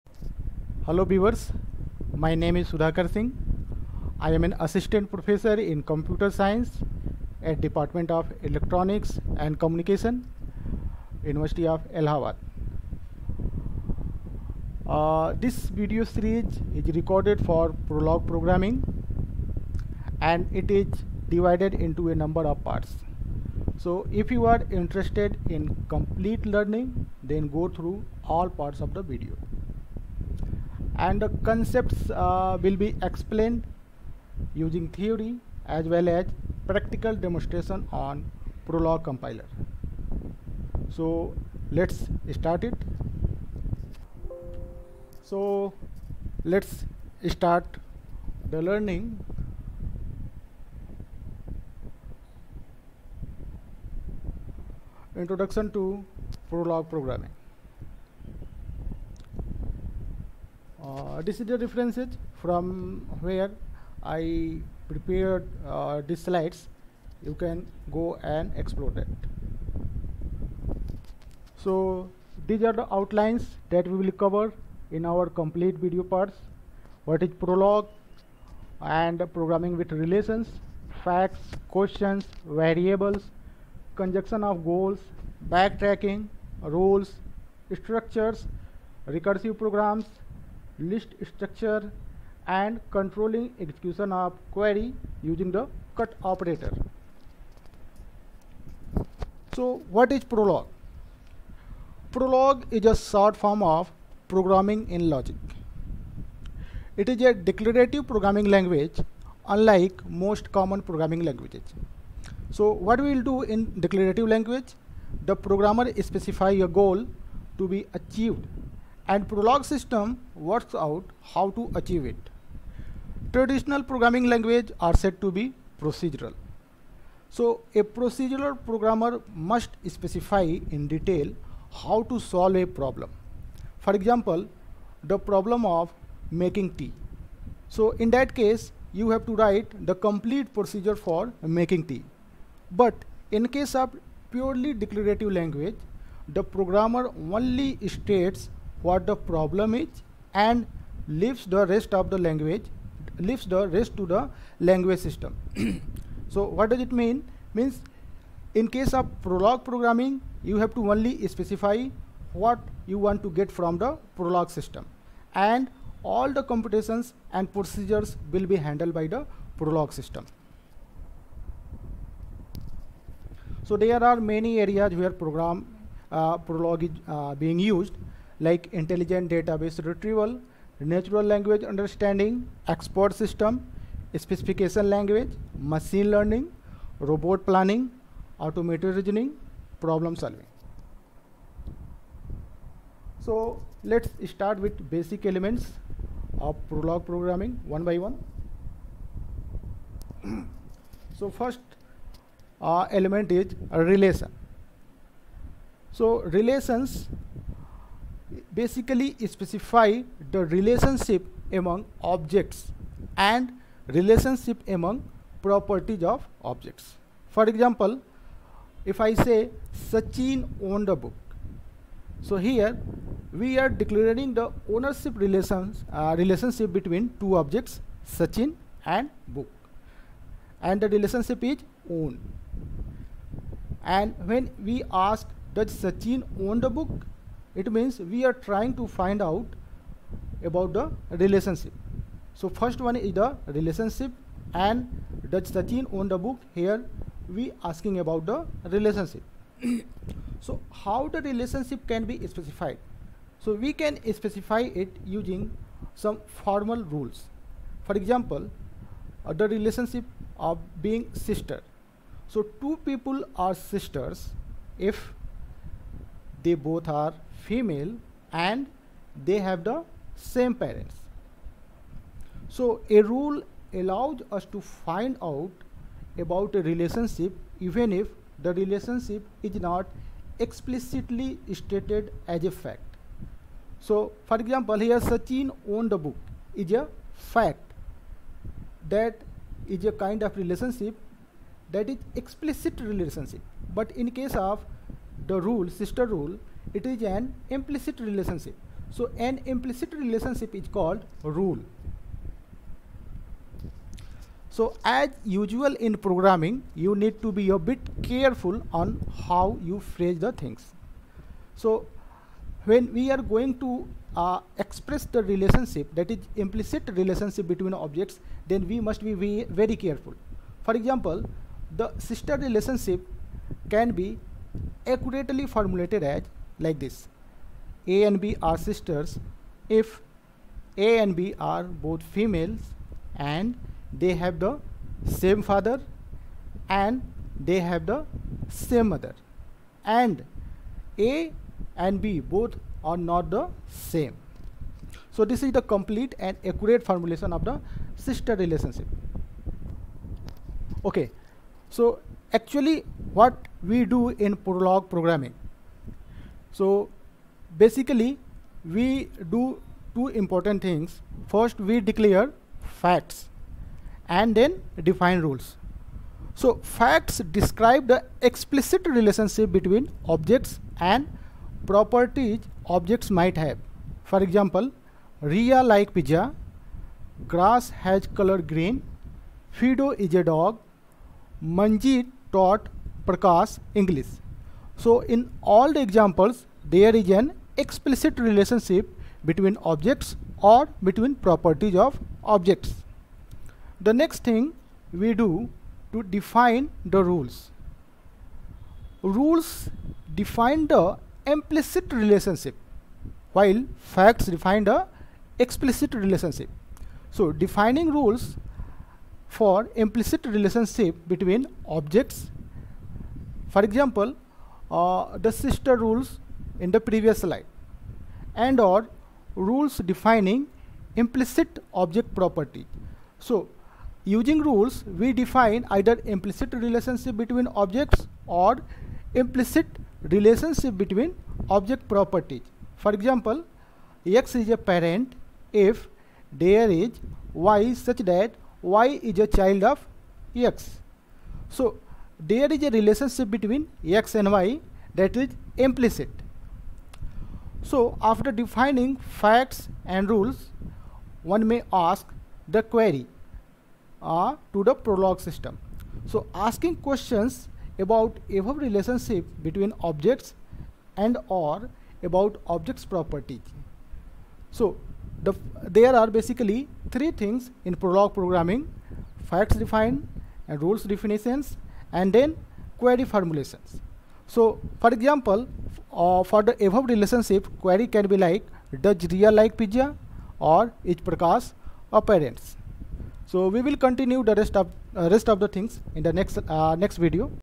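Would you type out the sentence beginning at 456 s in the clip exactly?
So asking questions about above relationship between objects and or about objects properties.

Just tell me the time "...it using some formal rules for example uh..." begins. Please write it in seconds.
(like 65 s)
254 s.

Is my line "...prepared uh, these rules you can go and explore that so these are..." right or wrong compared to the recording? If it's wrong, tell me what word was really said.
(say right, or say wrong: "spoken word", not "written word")
wrong: "slides", not "rules".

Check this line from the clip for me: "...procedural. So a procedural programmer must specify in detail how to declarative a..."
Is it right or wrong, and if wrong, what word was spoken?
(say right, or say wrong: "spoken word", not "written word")
wrong: "solve", not "declarative".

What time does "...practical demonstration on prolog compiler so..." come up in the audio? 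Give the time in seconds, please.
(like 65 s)
36 s.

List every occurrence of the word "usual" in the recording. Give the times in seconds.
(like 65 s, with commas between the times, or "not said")
305 s.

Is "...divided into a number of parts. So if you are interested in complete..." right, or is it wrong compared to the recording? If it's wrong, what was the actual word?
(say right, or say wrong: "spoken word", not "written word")
right.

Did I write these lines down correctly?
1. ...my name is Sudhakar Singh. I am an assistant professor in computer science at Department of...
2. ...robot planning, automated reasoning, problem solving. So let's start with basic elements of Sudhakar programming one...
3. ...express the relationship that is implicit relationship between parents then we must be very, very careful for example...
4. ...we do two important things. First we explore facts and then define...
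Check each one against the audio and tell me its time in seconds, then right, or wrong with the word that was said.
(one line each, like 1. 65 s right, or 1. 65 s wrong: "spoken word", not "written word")
1. 2 s right
2. 186 s wrong: "Prolog", not "Sudhakar"
3. 314 s wrong: "objects", not "parents"
4. 358 s wrong: "declare", not "explore".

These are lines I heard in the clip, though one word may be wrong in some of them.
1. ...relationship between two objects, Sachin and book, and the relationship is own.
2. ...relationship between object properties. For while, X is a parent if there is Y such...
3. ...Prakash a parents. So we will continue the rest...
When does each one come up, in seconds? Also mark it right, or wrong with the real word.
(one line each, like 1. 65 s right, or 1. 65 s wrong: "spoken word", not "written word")
1. 226 s right
2. 430 s wrong: "example", not "while"
3. 480 s right.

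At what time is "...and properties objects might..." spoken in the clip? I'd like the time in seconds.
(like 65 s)
370 s.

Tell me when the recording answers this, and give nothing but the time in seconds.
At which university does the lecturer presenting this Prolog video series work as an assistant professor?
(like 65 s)
11 s.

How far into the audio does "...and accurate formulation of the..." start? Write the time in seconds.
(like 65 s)
346 s.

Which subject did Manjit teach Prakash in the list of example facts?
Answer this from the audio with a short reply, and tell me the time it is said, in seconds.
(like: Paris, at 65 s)
English, at 383 s.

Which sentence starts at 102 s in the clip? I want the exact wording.
Prolog is a short form of programming in logic.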